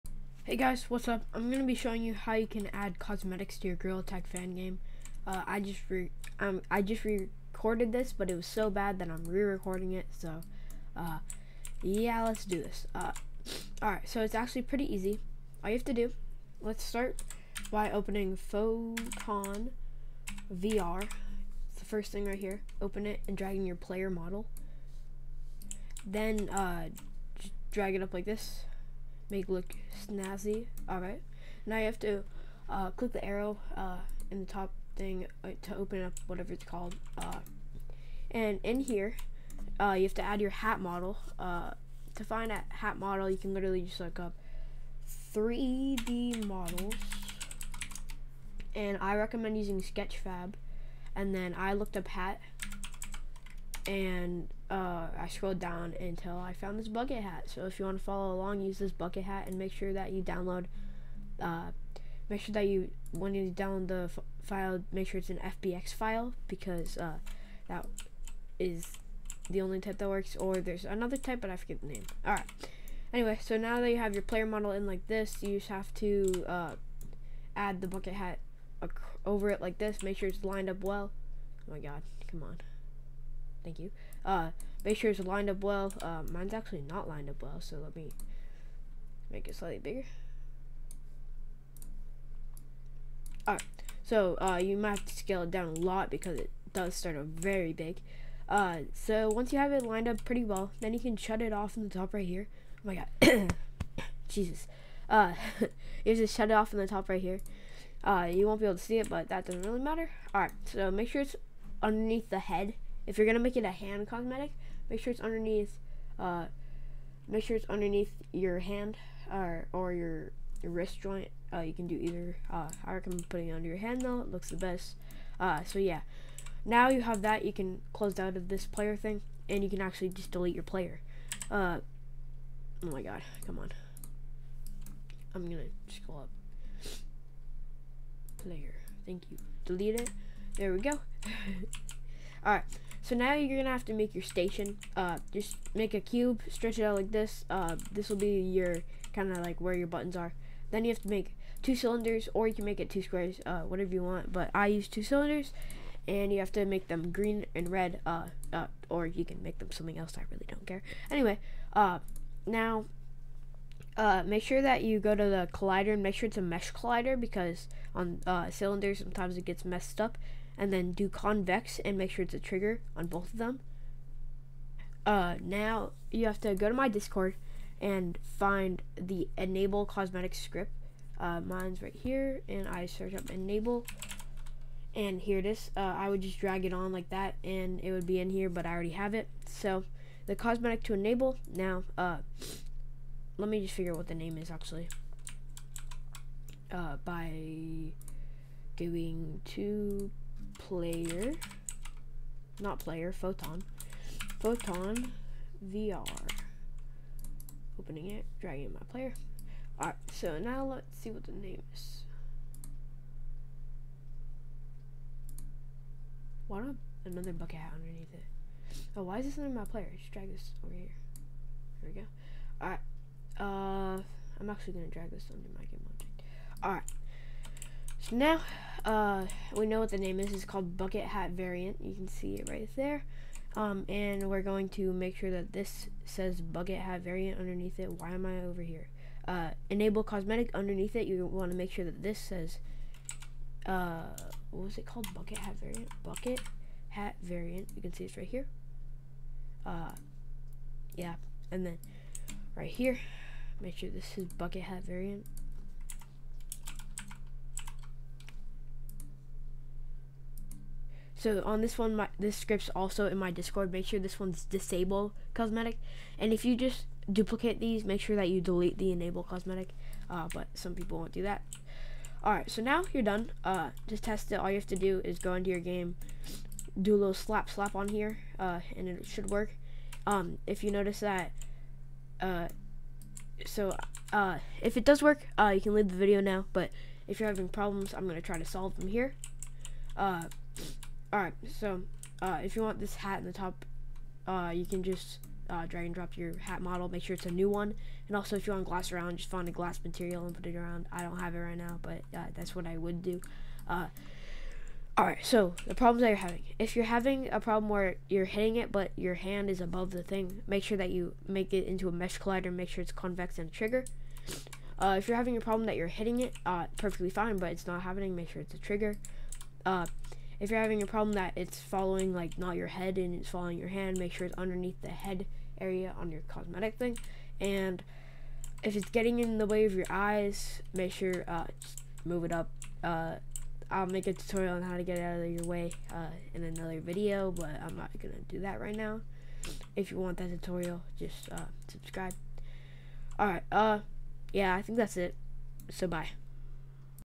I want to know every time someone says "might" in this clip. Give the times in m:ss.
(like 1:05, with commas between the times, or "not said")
1:34.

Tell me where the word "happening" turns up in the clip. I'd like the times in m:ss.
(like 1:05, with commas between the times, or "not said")
5:17.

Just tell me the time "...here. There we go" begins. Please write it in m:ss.
3:40.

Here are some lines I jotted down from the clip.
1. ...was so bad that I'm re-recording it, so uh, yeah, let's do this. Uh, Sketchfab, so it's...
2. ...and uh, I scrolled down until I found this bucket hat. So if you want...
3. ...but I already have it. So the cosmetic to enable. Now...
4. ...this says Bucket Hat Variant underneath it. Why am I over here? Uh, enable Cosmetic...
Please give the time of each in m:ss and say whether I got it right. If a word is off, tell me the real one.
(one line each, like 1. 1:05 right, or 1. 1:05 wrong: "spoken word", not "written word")
1. 0:08 wrong: "Alright", not "Sketchfab"
2. 0:53 right
3. 3:08 right
4. 3:55 right.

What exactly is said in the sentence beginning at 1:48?
Uh, you won't be able to see it, but that doesn't really matter.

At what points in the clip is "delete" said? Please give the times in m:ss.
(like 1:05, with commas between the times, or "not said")
2:10, 2:19, 4:28.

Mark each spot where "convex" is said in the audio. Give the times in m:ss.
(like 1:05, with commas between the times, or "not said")
2:51, 5:12.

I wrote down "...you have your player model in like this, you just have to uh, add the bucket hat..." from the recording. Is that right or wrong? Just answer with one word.
right.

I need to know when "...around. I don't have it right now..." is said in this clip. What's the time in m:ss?
5:00.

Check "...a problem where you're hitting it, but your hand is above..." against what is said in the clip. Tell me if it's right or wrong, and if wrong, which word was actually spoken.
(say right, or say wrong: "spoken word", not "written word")
right.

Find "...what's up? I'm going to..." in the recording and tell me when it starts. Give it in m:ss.
0:00.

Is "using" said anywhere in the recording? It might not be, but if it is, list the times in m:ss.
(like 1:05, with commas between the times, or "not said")
0:49.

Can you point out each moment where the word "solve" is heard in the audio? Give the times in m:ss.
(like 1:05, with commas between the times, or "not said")
4:48.